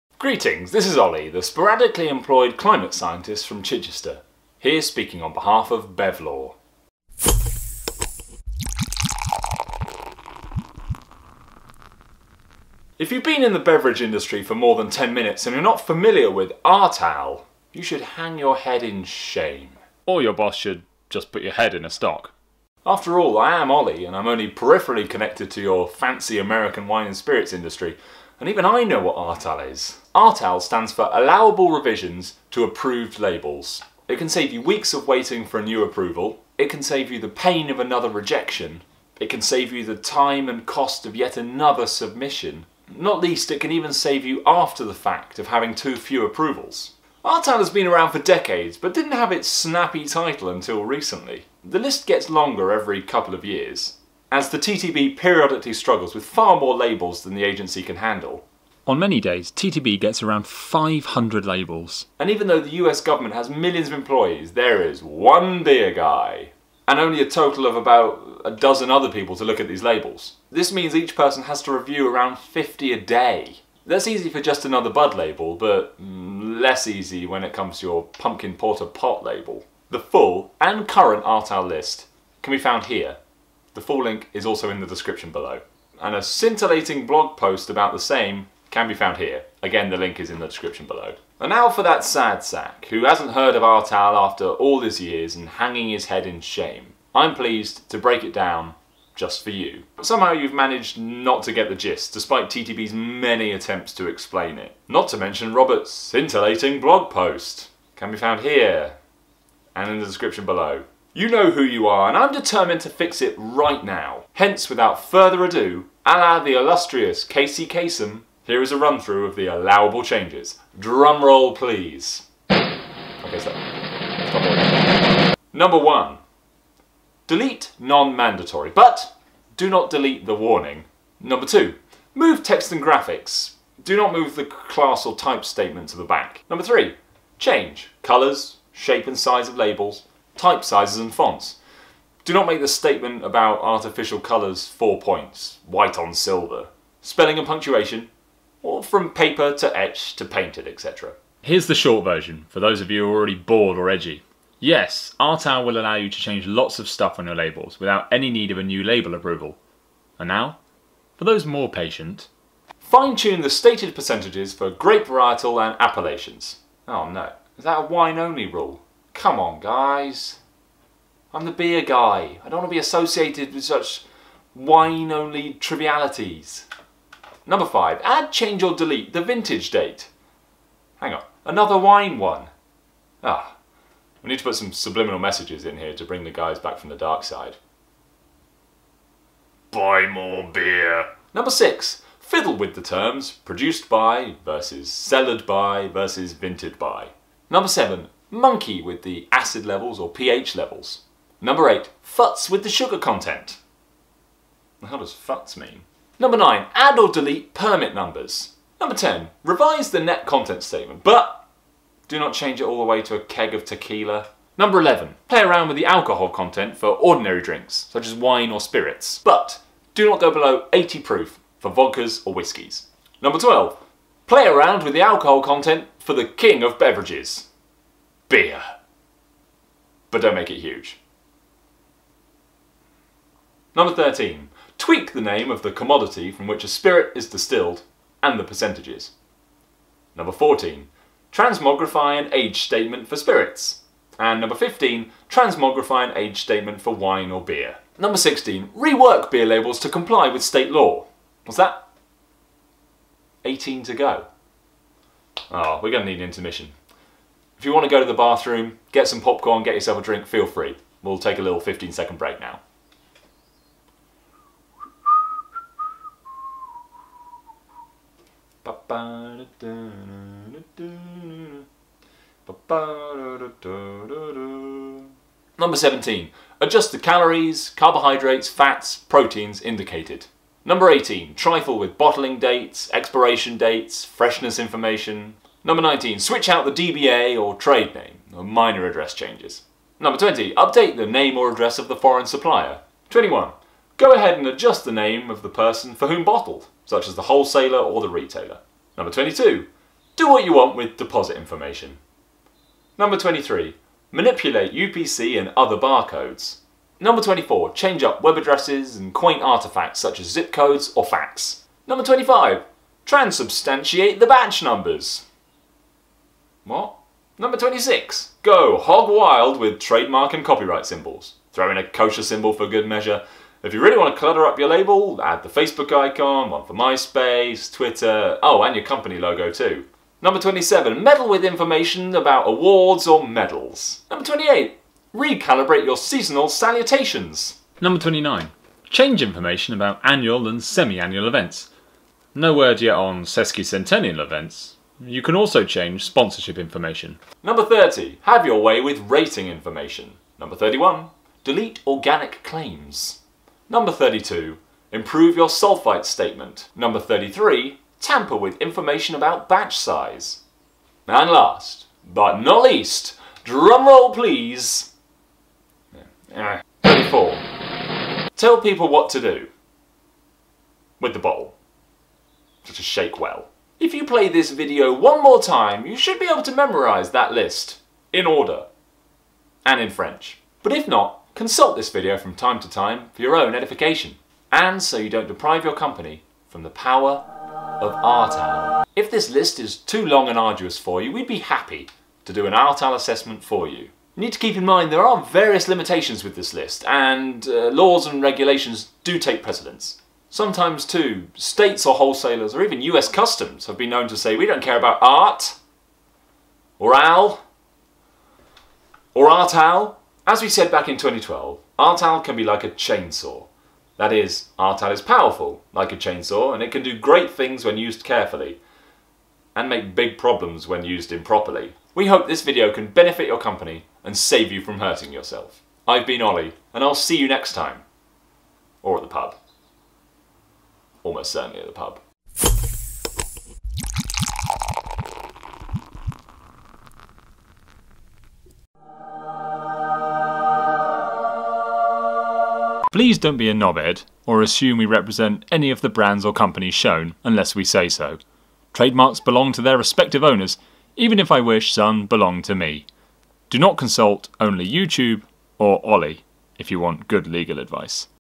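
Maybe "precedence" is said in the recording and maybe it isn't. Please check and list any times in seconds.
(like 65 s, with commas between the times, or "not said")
399 s.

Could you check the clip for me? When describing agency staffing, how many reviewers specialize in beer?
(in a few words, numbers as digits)
1.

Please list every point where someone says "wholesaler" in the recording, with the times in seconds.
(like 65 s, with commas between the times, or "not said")
297 s, 401 s.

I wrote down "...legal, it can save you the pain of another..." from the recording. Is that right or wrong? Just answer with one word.
wrong.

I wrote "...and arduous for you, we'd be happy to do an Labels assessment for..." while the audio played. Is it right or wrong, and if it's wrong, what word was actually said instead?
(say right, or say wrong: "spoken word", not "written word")
wrong: "Artal", not "Labels".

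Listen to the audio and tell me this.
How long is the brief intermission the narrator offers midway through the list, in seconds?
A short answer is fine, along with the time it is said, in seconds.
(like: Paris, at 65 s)
15, at 261 s.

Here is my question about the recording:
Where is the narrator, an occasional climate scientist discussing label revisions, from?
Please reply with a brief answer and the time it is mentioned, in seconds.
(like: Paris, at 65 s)
Chichester, at 3 s.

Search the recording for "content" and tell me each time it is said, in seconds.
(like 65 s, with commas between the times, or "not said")
202 s, 210 s, 216 s, 225 s.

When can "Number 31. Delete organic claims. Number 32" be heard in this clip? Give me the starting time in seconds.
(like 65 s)
350 s.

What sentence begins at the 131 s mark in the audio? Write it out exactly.
Number two, move text and graphics.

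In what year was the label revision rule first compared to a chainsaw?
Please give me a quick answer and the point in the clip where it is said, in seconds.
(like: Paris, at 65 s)
2012, at 410 s.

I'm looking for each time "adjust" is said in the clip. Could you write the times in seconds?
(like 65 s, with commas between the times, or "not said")
276 s, 294 s.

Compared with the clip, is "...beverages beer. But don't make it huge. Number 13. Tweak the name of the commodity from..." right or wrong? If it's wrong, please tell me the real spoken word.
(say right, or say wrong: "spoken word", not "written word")
right.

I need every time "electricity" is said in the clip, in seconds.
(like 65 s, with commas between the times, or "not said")
not said.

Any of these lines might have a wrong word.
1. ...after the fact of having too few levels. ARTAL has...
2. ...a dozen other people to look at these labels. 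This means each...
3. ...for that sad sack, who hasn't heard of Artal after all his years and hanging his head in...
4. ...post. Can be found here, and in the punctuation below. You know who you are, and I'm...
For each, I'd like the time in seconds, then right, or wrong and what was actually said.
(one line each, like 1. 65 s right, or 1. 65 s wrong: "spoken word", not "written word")
1. 44 s wrong: "approvals", not "levels"
2. 68 s right
3. 91 s right
4. 107 s wrong: "description", not "punctuation".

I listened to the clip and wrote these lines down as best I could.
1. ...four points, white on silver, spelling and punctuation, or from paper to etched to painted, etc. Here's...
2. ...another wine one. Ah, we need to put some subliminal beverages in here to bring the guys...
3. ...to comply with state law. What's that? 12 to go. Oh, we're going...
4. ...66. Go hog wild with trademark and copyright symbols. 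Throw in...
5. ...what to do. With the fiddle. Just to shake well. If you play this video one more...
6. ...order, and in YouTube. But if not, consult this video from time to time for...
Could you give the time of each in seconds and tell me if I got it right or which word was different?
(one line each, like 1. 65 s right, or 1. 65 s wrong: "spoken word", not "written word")
1. 144 s right
2. 181 s wrong: "messages", not "beverages"
3. 249 s wrong: "18", not "12"
4. 317 s wrong: "26", not "66"
5. 368 s wrong: "bottle", not "fiddle"
6. 378 s wrong: "French", not "YouTube".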